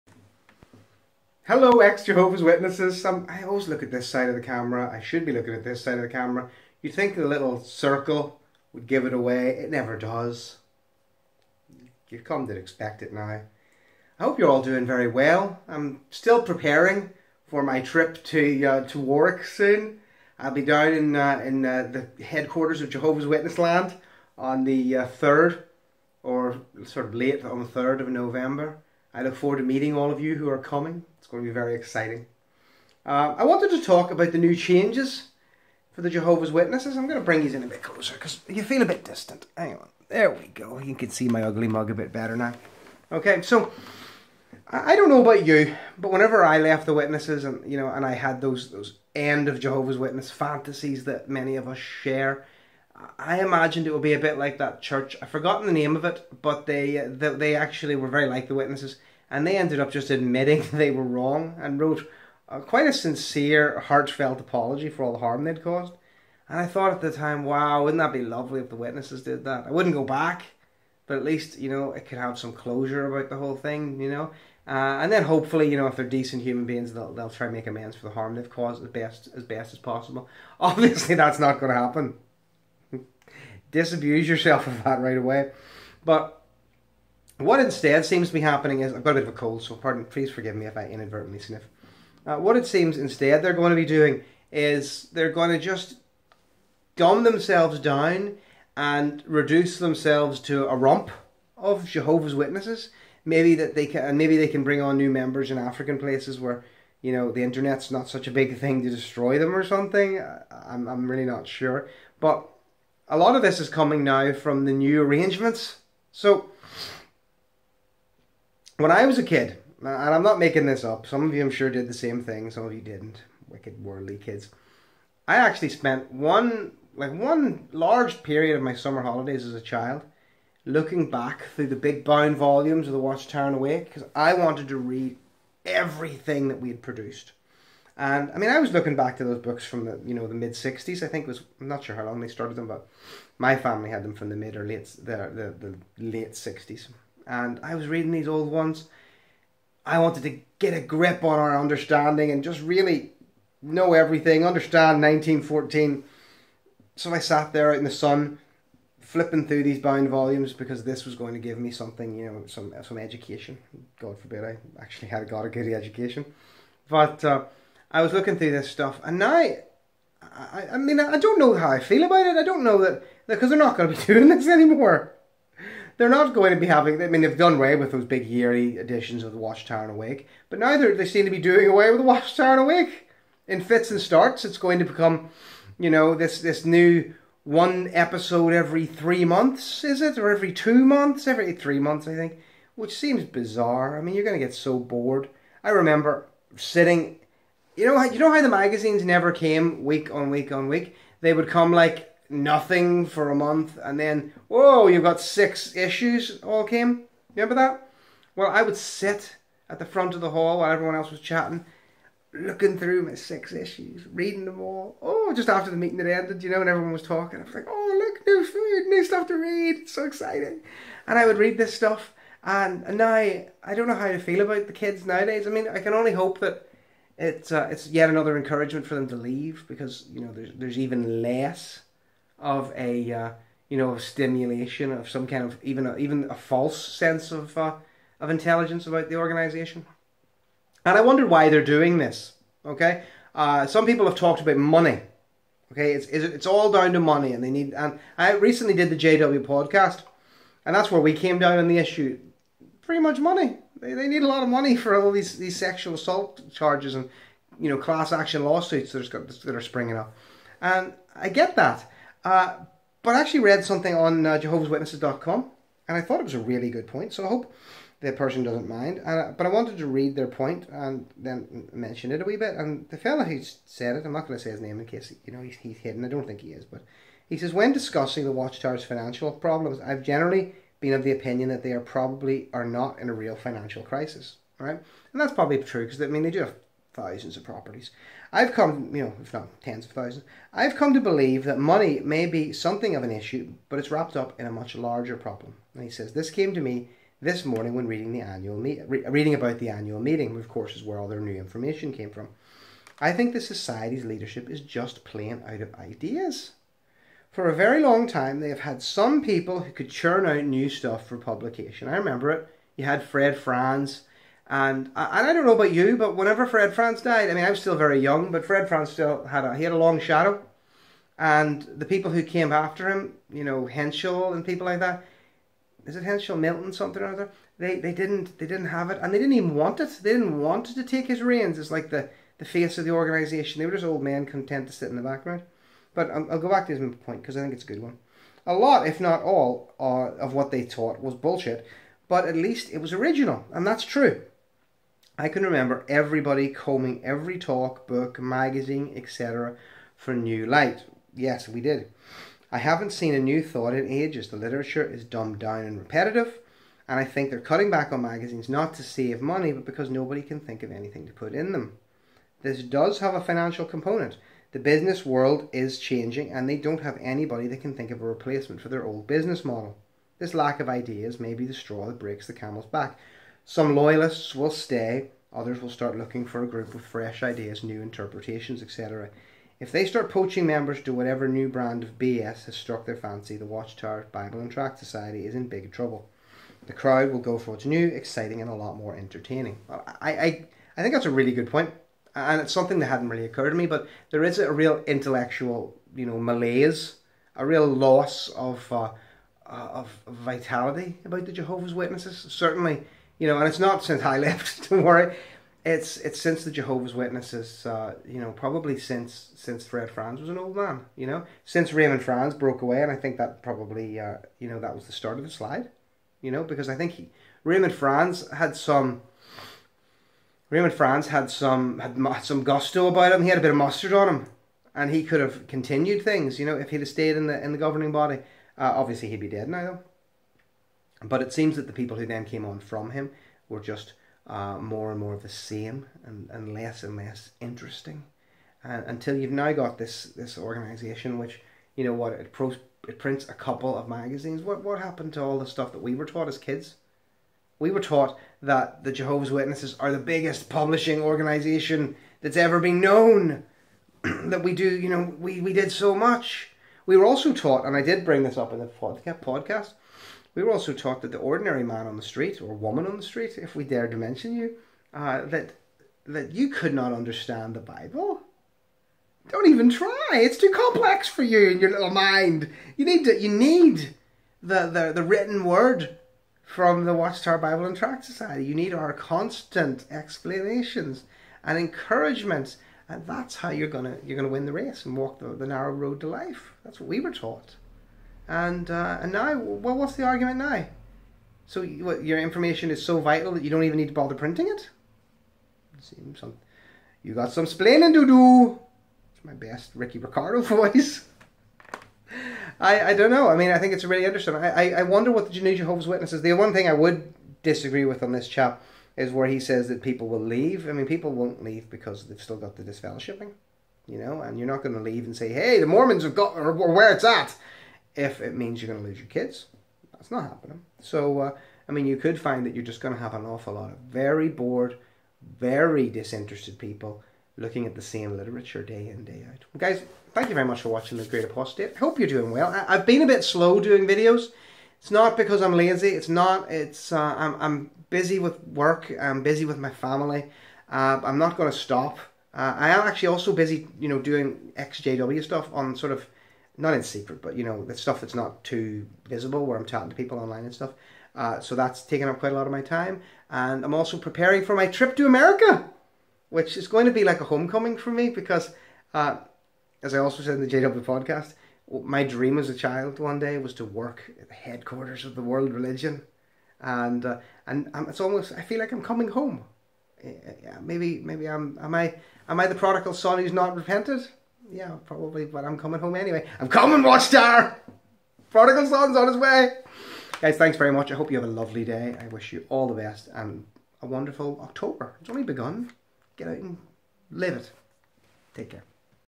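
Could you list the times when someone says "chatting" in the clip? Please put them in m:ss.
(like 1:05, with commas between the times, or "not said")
3:31, 9:09.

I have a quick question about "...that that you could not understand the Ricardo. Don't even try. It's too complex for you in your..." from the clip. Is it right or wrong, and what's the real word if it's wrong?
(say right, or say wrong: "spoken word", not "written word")
wrong: "Bible", not "Ricardo".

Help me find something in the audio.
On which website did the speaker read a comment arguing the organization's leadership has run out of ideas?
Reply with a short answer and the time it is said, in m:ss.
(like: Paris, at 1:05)
Jehovah's Witnesses.com, at 4:24.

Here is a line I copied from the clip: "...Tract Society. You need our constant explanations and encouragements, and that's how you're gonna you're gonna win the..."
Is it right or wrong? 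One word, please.
right.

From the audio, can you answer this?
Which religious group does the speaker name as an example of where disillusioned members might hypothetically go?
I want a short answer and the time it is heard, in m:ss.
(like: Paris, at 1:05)
The Mormons, at 8:35.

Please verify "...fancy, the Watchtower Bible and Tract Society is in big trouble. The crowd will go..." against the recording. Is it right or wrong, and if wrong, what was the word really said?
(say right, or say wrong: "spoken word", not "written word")
right.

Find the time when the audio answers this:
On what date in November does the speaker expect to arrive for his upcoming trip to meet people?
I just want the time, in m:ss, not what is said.
0:27.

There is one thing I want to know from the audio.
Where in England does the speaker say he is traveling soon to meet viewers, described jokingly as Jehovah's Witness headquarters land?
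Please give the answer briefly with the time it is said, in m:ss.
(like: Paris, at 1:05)
Warwick, at 0:18.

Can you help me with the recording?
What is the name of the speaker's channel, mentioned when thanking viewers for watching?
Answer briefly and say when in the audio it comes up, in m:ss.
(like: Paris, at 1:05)
The Great Apostate, at 8:50.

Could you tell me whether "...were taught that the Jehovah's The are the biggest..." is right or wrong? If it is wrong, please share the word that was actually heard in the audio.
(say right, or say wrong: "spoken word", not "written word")
wrong: "Witnesses", not "The".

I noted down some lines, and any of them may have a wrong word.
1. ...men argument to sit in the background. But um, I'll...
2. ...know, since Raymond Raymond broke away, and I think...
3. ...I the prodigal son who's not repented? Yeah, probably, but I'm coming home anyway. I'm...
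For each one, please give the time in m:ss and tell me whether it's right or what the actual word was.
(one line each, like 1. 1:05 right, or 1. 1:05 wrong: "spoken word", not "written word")
1. 5:34 wrong: "content", not "argument"
2. 6:51 wrong: "Franz", not "Raymond"
3. 9:32 right.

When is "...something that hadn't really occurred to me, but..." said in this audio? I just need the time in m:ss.
6:32.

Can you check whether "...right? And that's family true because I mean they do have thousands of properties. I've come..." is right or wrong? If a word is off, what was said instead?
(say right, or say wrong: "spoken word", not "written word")
wrong: "probably", not "family".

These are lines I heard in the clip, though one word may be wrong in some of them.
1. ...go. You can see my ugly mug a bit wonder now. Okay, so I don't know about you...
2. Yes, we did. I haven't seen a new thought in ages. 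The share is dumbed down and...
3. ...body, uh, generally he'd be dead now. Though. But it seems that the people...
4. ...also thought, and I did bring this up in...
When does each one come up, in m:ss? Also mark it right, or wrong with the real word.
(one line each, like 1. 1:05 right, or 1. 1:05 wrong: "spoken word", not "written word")
1. 0:40 wrong: "better", not "wonder"
2. 5:51 wrong: "literature", not "share"
3. 7:07 wrong: "obviously", not "generally"
4. 7:37 wrong: "taught", not "thought".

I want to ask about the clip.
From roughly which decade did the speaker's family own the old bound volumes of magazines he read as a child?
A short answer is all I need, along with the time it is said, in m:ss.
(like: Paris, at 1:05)
1960s, at 2:26.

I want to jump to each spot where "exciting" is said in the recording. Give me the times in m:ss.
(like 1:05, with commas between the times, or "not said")
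0:31, 3:40, 6:27.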